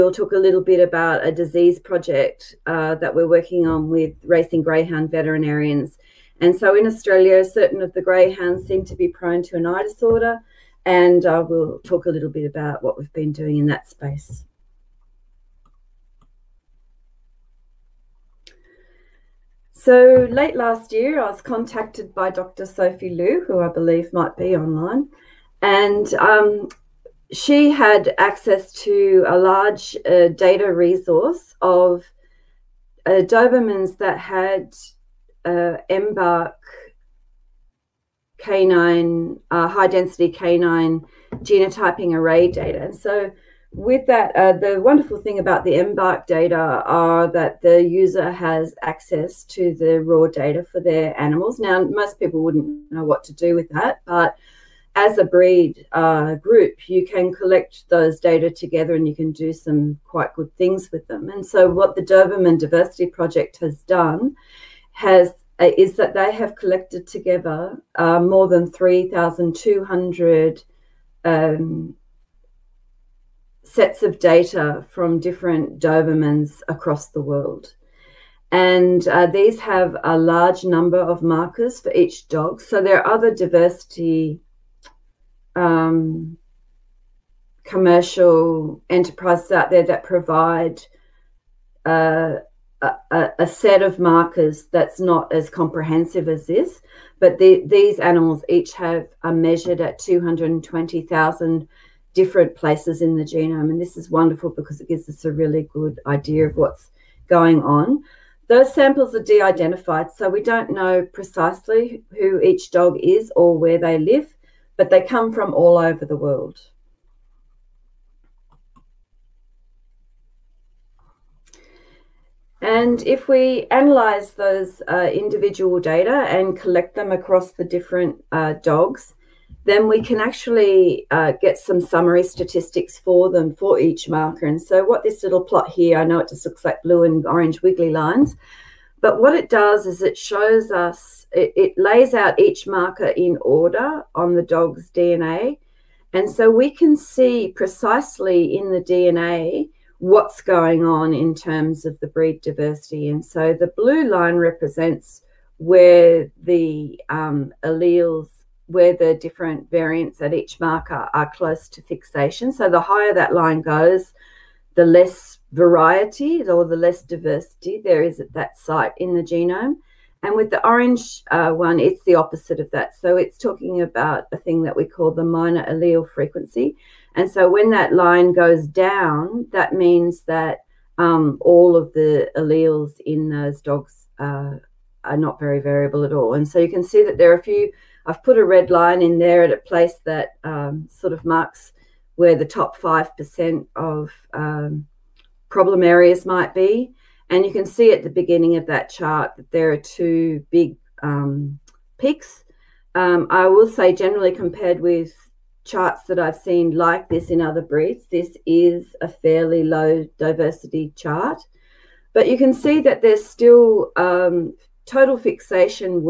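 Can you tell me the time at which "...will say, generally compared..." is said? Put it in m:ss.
3:23.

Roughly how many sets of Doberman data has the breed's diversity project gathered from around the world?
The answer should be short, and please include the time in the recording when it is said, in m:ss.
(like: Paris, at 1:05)
more than 3,200, at 1:08.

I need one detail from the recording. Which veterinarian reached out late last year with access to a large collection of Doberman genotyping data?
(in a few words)
Dr. Sophie Liu.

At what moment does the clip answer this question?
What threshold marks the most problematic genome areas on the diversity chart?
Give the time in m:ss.
3:12.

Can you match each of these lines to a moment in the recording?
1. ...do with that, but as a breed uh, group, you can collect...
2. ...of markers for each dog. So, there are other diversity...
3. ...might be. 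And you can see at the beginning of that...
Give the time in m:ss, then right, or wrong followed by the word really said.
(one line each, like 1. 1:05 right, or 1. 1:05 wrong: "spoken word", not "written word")
1. 0:53 right
2. 1:20 right
3. 3:16 right.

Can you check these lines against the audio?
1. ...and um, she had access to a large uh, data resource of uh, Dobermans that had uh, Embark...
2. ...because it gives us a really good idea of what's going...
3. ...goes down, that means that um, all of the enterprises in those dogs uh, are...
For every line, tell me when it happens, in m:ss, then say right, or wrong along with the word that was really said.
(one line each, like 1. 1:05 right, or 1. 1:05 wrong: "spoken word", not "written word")
1. 0:25 right
2. 1:44 right
3. 2:58 wrong: "alleles", not "enterprises".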